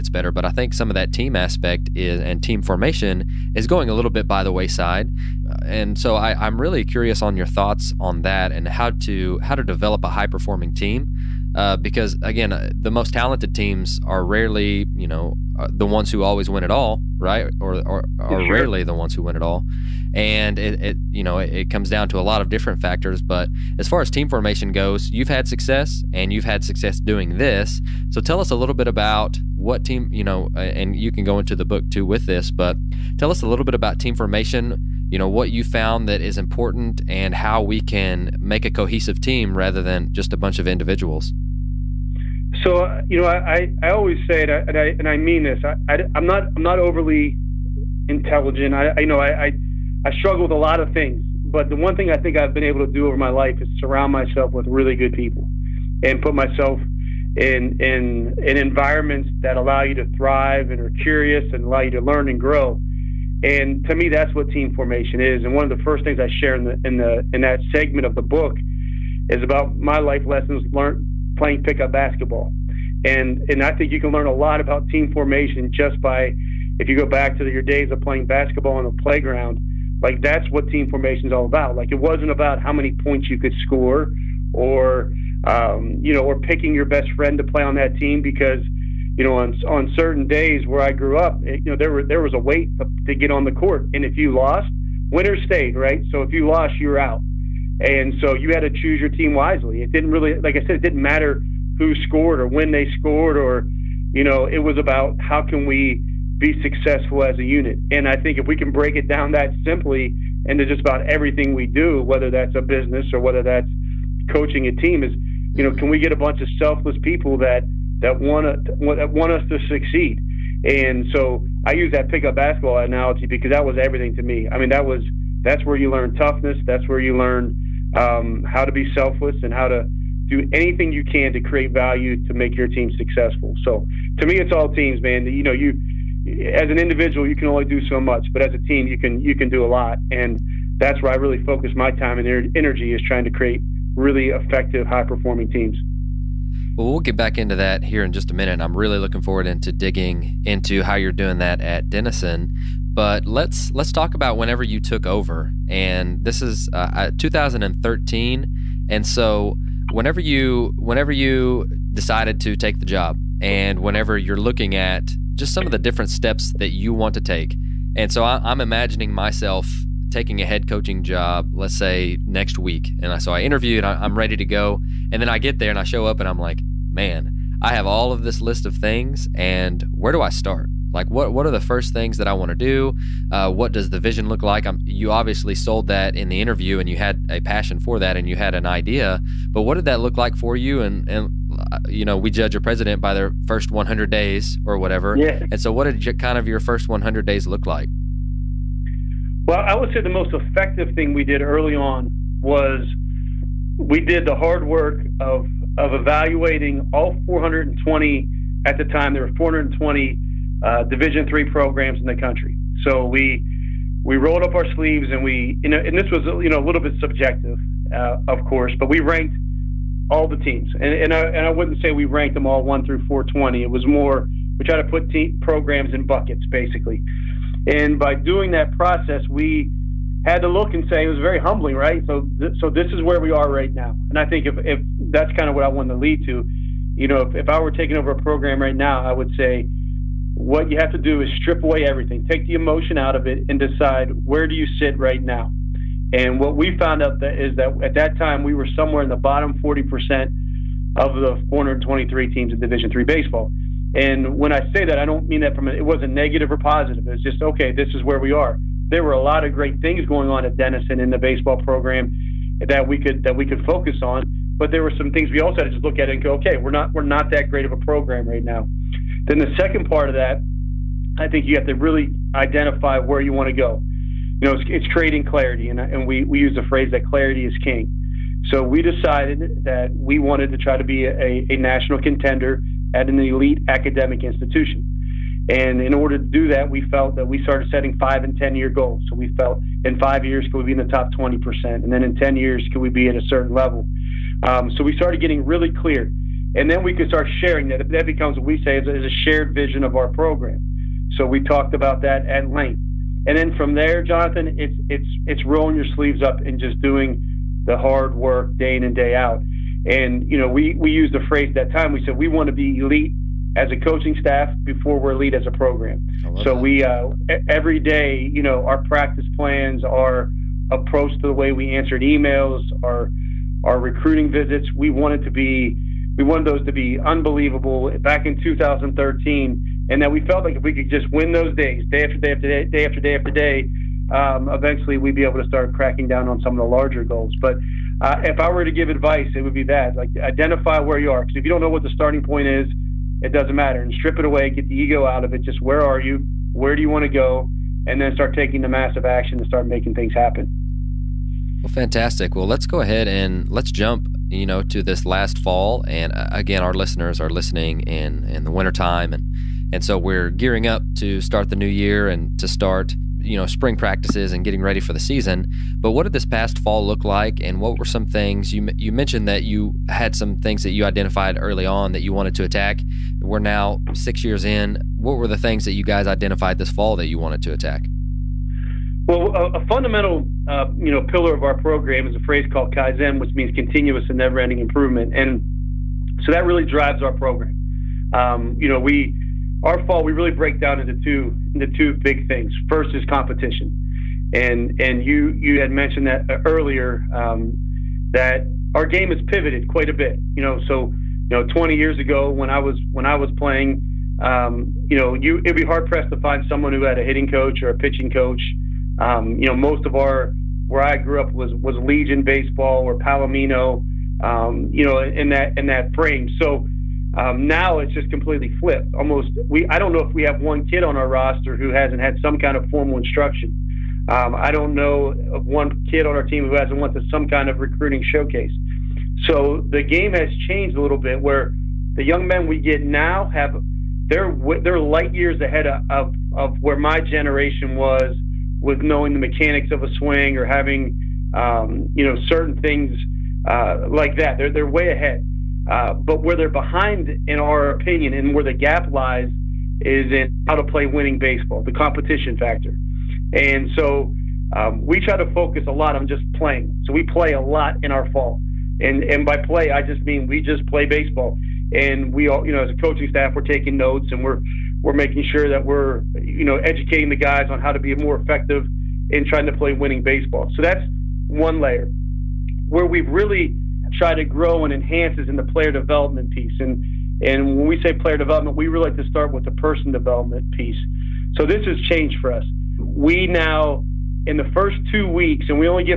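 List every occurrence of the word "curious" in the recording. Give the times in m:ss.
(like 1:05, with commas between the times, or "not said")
0:06, 1:01.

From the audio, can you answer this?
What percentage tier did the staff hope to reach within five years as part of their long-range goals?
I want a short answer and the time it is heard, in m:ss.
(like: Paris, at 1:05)
top 20%, at 4:50.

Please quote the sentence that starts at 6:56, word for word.
So um, now it's just completely flipped.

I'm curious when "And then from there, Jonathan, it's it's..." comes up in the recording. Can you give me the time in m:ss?
5:03.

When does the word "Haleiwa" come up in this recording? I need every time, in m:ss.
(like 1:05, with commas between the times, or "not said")
not said.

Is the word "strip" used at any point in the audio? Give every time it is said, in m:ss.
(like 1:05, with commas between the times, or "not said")
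4:01, 5:43.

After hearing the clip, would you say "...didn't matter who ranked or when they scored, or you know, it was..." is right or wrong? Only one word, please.
wrong.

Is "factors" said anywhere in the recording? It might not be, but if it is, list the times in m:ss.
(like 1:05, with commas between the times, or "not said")
0:22, 7:32.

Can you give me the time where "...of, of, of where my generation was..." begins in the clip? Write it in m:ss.
7:15.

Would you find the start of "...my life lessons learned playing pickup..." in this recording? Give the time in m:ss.
1:09.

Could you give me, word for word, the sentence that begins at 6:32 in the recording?
First is competition, and and you you had mentioned that uh, earlier um, that our game has pivoted quite a bit.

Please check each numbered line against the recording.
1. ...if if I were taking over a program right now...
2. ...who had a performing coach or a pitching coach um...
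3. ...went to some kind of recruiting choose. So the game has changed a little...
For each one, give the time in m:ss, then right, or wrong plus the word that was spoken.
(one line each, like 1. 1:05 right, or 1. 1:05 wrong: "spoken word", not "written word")
1. 3:57 right
2. 6:46 wrong: "hitting", not "performing"
3. 7:06 wrong: "showcase", not "choose".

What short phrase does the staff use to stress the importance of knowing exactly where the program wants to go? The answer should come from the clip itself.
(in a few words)
clarity is king.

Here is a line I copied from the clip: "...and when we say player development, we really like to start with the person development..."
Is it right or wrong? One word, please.
right.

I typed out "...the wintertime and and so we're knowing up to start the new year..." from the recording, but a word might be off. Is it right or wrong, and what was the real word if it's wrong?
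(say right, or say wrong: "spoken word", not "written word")
wrong: "gearing", not "knowing".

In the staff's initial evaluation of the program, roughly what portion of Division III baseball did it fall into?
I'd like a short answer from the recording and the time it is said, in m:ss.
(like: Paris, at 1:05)
bottom 40%, at 4:09.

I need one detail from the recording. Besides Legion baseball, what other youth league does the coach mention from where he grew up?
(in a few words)
Palomino.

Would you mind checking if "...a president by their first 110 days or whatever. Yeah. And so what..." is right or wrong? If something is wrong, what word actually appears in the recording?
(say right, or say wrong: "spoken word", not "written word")
wrong: "100", not "110".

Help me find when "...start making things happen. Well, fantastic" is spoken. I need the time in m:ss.
5:49.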